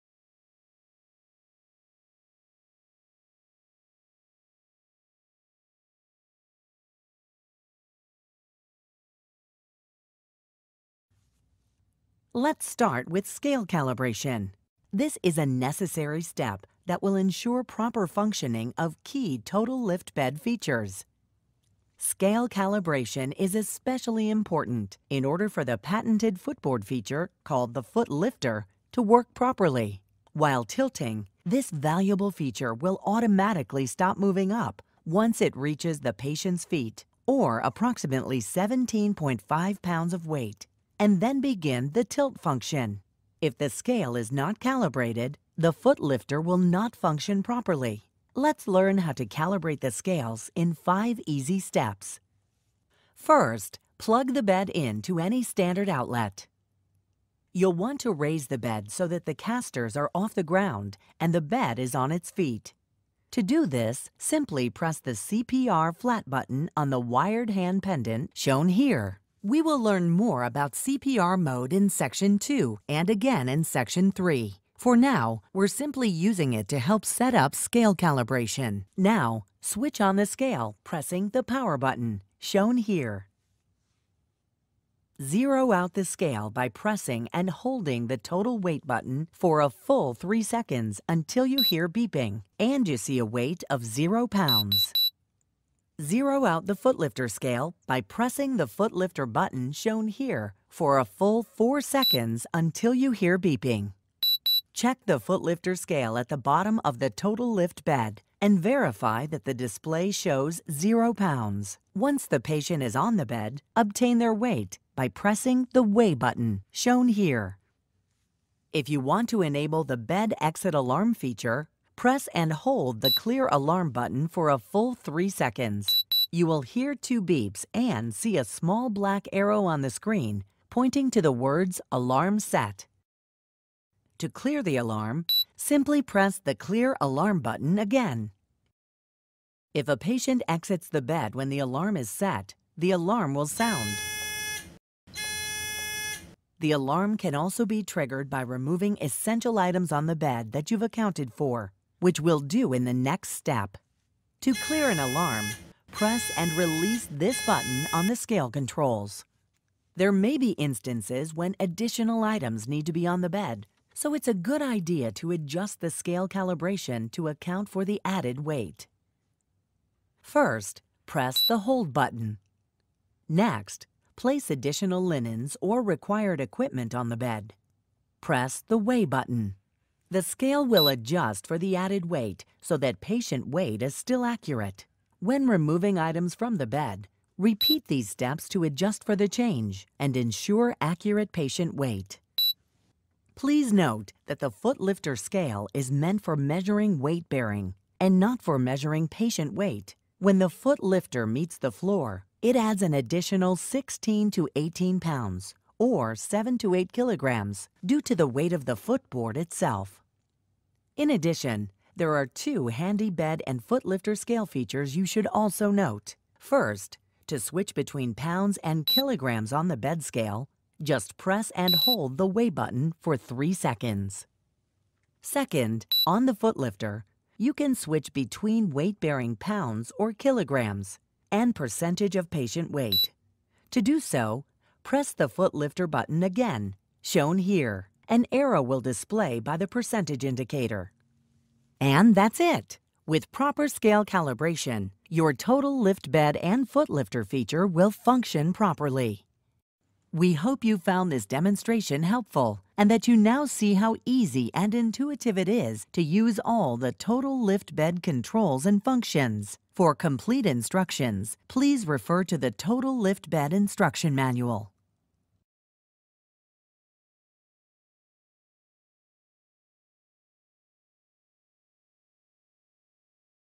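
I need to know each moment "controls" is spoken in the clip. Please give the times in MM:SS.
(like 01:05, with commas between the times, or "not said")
02:38, 04:18.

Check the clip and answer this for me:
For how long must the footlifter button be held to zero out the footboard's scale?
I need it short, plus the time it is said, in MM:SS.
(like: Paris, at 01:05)
4 seconds, at 01:41.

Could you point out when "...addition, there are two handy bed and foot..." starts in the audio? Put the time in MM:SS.
03:31.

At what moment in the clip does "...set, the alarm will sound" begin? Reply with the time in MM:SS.
02:22.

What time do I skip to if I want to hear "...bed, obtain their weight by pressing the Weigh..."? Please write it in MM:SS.
01:53.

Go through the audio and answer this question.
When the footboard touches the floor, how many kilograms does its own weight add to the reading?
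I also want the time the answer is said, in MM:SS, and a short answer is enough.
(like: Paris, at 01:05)
7 to 8 kilograms, at 03:26.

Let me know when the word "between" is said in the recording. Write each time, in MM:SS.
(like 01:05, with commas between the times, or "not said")
03:37, 03:48.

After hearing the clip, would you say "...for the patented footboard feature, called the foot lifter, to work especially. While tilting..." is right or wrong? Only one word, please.
wrong.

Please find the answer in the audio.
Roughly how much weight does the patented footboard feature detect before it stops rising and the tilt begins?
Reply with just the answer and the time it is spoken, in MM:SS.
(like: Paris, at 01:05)
17.5 pounds, at 00:38.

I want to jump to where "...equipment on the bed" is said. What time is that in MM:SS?
02:56.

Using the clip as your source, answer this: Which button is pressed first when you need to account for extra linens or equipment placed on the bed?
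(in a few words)
Hold button.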